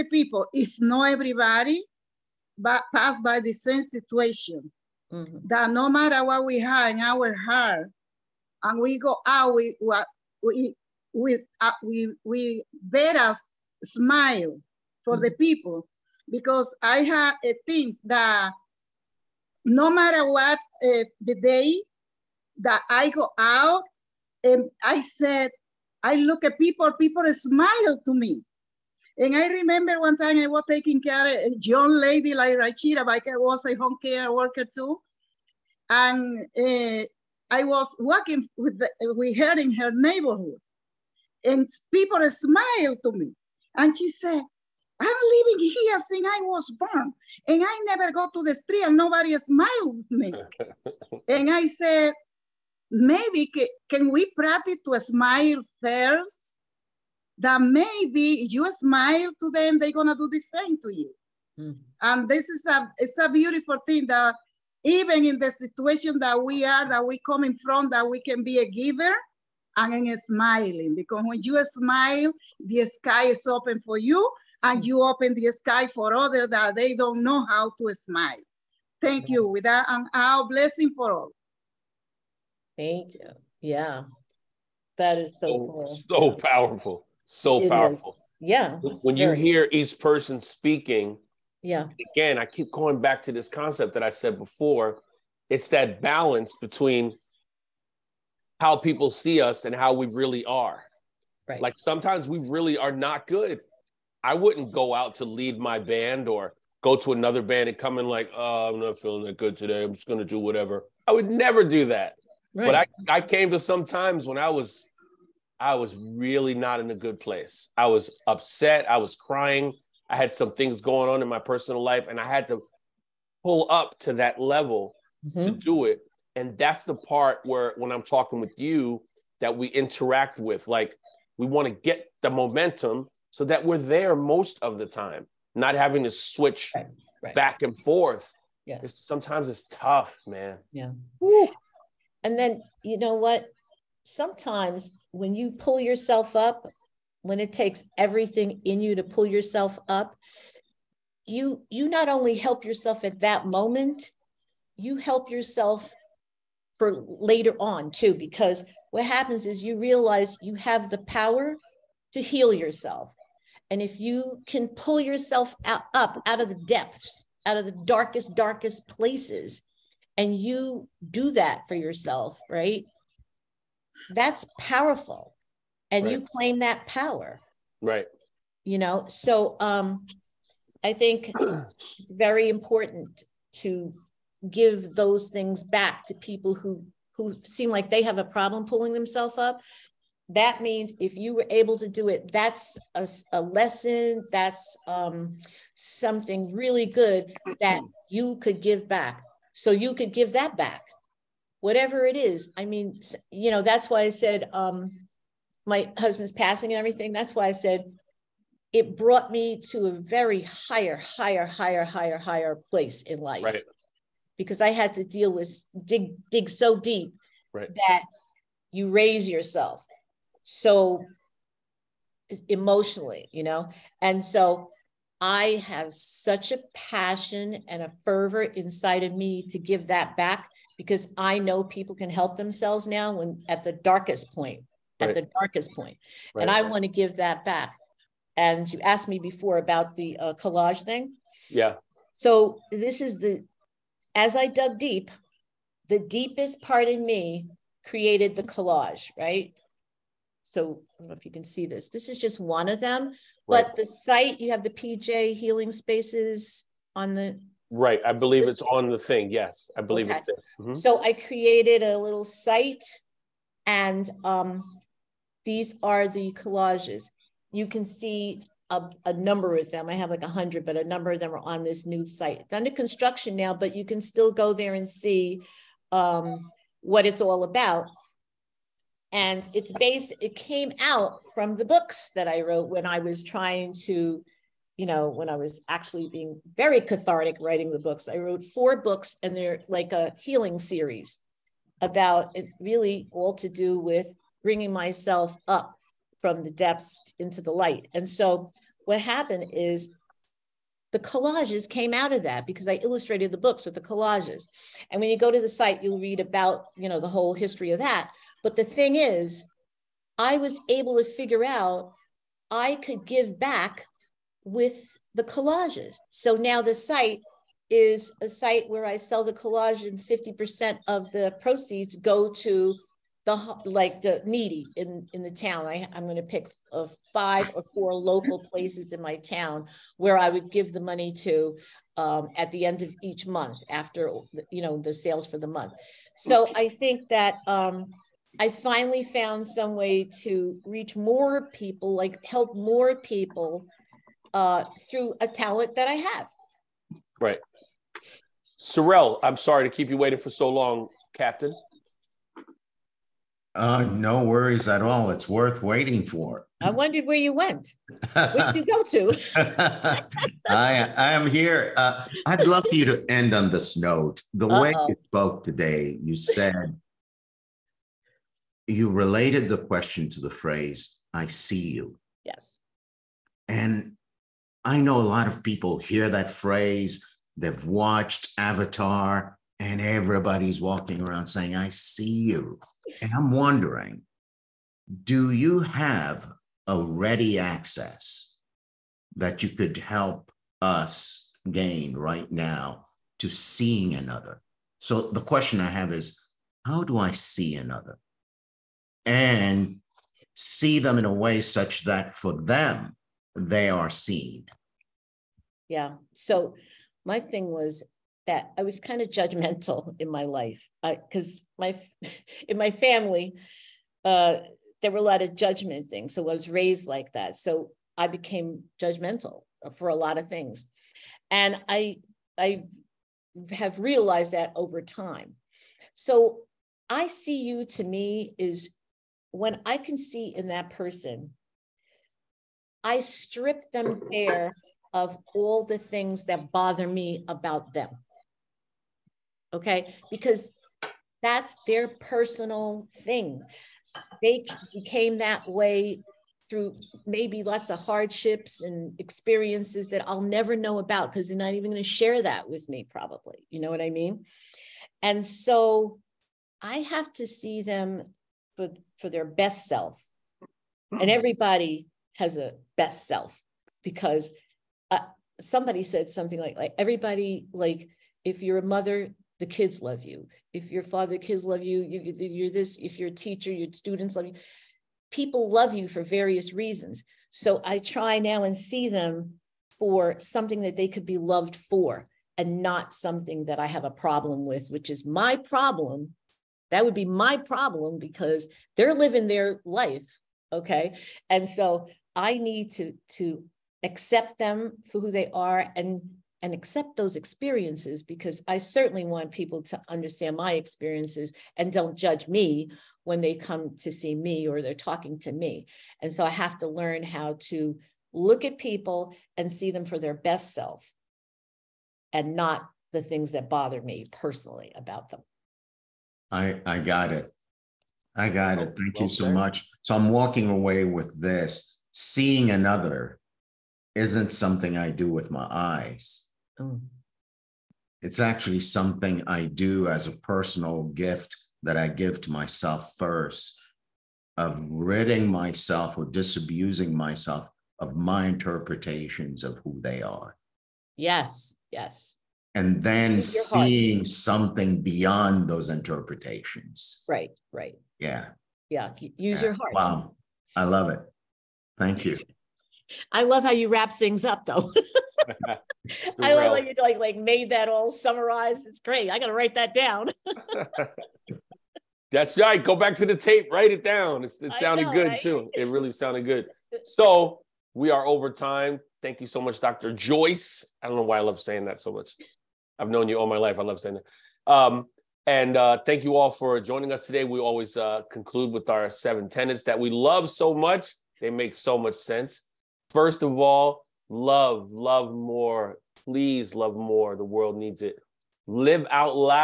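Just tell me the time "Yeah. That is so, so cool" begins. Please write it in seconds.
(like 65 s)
83 s.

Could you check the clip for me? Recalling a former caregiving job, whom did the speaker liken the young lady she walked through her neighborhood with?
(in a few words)
Rashida.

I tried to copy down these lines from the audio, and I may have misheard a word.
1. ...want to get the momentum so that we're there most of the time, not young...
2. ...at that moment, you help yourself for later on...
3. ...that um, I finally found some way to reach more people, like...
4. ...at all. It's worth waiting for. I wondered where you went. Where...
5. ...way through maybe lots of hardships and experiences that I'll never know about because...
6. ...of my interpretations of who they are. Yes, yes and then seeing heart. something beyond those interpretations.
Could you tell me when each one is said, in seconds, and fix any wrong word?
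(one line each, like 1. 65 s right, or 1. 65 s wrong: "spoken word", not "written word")
1. 131 s wrong: "having", not "young"
2. 153 s right
3. 337 s right
4. 354 s right
5. 445 s right
6. 537 s right.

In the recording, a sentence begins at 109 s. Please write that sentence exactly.
I'm just going to do whatever.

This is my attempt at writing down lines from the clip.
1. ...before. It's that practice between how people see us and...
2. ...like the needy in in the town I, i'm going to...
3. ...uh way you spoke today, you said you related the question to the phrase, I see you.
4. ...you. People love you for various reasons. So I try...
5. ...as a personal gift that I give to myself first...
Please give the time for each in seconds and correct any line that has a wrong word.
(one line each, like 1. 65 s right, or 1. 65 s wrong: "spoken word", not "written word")
1. 94 s wrong: "balance", not "practice"
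2. 323 s right
3. 364 s right
4. 474 s right
5. 529 s right.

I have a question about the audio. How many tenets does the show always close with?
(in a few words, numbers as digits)
7.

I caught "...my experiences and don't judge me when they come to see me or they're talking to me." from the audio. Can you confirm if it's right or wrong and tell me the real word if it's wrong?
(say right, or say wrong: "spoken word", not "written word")
right.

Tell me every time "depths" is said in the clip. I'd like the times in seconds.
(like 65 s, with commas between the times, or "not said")
166 s, 296 s.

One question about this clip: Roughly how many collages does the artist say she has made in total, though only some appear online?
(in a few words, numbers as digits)
100.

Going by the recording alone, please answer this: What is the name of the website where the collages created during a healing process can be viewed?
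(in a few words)
PJ Healing Spaces.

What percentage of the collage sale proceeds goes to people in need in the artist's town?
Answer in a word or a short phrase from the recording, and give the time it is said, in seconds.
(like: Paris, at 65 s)
50%, at 319 s.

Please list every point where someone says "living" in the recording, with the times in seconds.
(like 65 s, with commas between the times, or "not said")
45 s, 488 s.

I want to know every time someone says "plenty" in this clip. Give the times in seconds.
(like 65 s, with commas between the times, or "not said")
not said.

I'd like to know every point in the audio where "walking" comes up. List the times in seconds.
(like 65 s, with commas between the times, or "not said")
37 s, 380 s, 520 s.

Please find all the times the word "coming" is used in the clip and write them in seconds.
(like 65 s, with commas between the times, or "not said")
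67 s.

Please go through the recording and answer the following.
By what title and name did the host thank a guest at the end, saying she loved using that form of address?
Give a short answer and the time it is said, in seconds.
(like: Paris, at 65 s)
Dr. Joyce, at 569 s.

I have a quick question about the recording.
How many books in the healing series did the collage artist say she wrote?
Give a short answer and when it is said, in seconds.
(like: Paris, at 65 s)
4, at 288 s.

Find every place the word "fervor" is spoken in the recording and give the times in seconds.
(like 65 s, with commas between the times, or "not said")
228 s.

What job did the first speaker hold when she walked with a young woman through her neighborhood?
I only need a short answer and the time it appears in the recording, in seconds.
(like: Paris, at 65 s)
home care worker, at 33 s.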